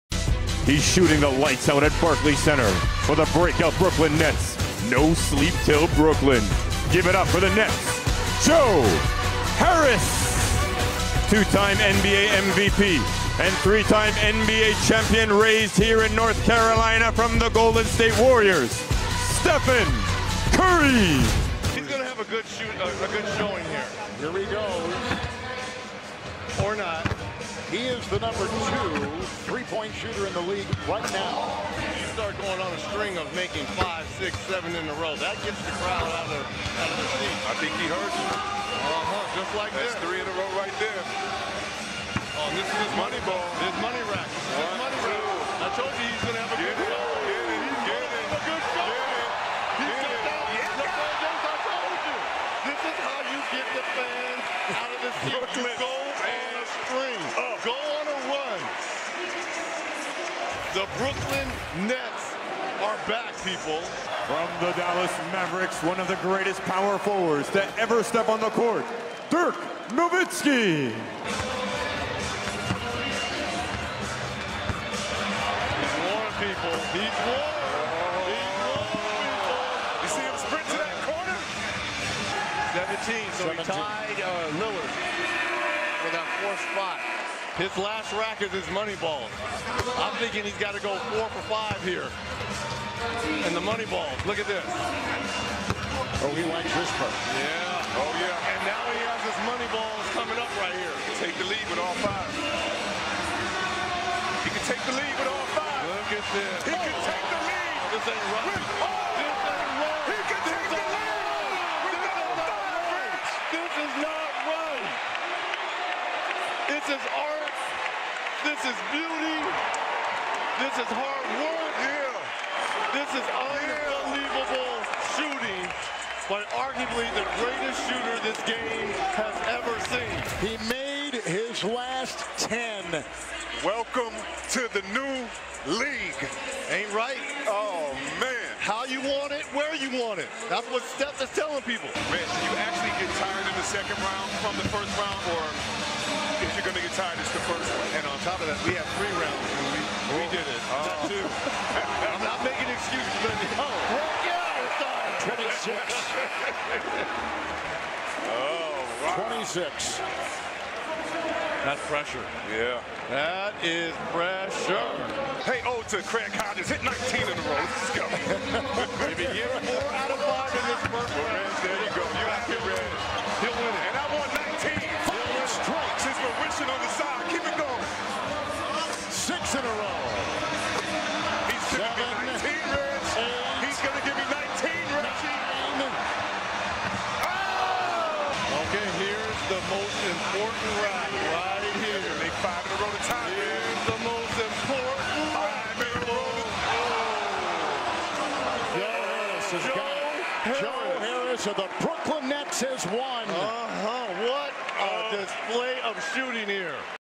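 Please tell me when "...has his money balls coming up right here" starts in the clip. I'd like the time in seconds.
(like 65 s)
99 s.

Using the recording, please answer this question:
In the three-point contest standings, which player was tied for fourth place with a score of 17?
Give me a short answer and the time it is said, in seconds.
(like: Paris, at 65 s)
Lillard, at 84 s.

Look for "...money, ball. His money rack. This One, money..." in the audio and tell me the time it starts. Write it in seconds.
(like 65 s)
42 s.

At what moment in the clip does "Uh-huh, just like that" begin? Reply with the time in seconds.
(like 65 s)
38 s.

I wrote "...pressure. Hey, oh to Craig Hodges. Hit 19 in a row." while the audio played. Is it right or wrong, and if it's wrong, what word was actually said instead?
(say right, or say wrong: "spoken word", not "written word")
right.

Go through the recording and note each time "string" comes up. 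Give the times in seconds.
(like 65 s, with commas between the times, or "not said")
32 s, 56 s.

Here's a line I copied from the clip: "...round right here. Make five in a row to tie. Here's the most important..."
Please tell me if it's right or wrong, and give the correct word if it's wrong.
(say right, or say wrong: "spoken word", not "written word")
right.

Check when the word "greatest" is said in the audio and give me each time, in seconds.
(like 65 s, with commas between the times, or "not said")
66 s, 127 s.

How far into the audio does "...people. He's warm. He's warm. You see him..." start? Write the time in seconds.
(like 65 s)
76 s.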